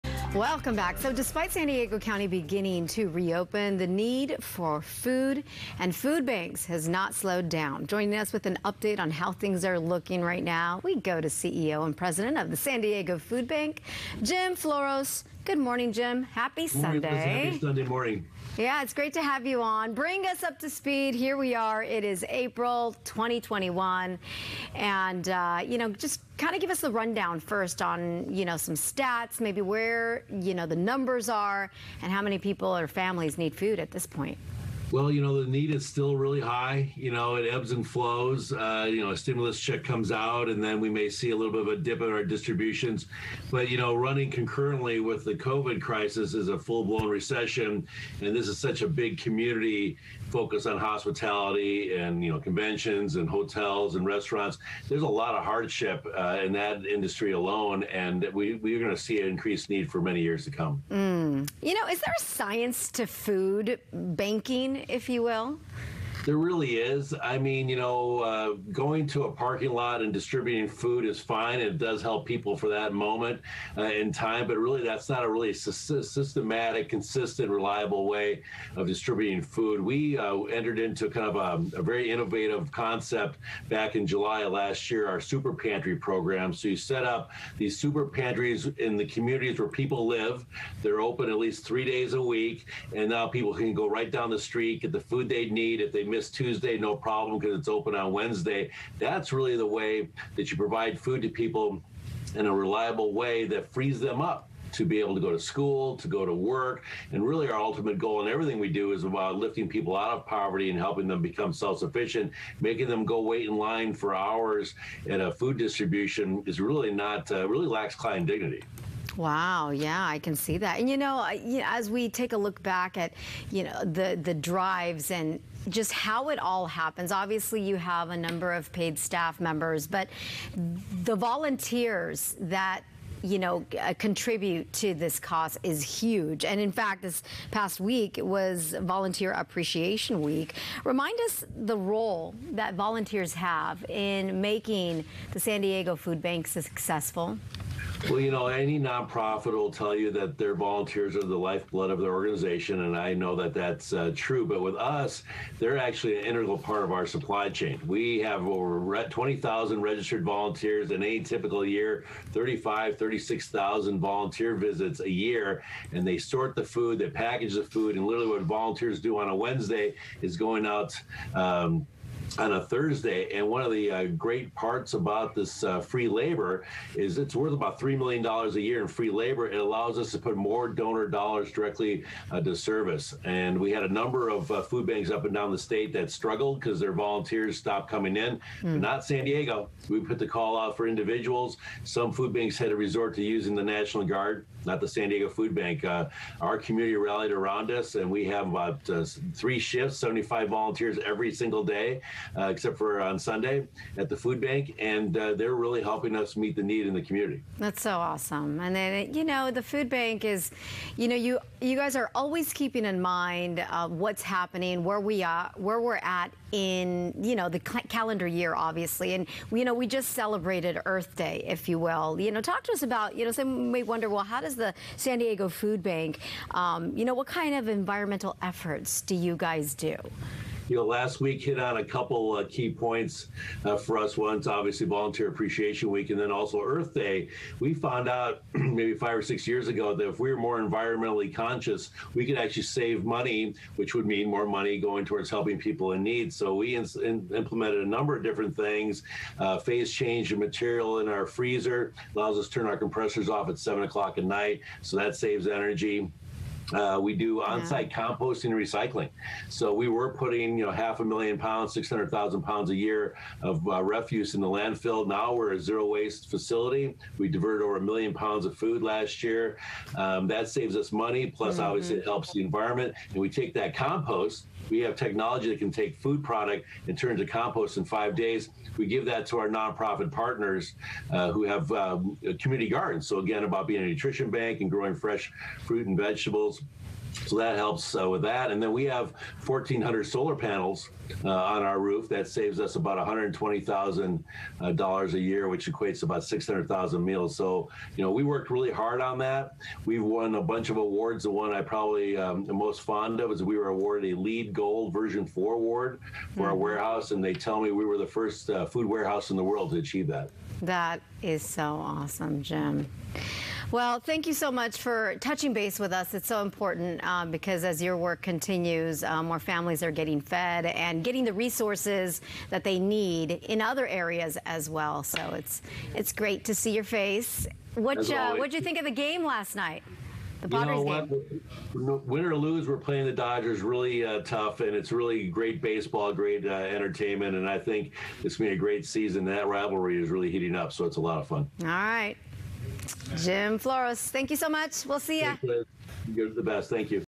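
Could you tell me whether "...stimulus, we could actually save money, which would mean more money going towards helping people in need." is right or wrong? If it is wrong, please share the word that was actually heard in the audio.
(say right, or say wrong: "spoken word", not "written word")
wrong: "conscious", not "stimulus".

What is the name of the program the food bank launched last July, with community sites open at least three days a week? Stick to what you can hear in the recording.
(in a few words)
super pantry program.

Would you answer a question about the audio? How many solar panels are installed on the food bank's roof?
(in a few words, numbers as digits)
1,400.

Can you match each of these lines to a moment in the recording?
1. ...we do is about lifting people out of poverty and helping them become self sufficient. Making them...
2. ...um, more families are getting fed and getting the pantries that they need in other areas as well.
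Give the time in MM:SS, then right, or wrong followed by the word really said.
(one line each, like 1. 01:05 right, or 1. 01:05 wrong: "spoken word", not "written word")
1. 01:48 right
2. 05:19 wrong: "resources", not "pantries".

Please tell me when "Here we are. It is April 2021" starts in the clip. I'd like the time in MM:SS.
00:21.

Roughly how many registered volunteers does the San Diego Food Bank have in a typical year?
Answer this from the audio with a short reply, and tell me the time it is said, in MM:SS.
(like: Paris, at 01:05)
over 20,000, at 02:38.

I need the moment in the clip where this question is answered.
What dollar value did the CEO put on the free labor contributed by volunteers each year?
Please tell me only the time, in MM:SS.
02:57.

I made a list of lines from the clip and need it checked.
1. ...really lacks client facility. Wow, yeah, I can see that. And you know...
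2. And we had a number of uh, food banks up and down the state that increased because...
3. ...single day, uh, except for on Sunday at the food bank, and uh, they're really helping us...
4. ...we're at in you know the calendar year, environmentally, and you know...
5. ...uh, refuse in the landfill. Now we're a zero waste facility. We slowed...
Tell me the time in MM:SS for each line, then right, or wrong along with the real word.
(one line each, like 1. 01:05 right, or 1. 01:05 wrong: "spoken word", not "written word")
1. 01:57 wrong: "dignity", not "facility"
2. 03:03 wrong: "struggled", not "increased"
3. 03:21 right
4. 03:35 wrong: "obviously", not "environmentally"
5. 04:23 wrong: "diverted", not "slowed".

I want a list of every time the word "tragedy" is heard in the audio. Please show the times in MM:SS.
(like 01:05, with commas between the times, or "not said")
not said.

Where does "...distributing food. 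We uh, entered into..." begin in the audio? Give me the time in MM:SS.
01:18.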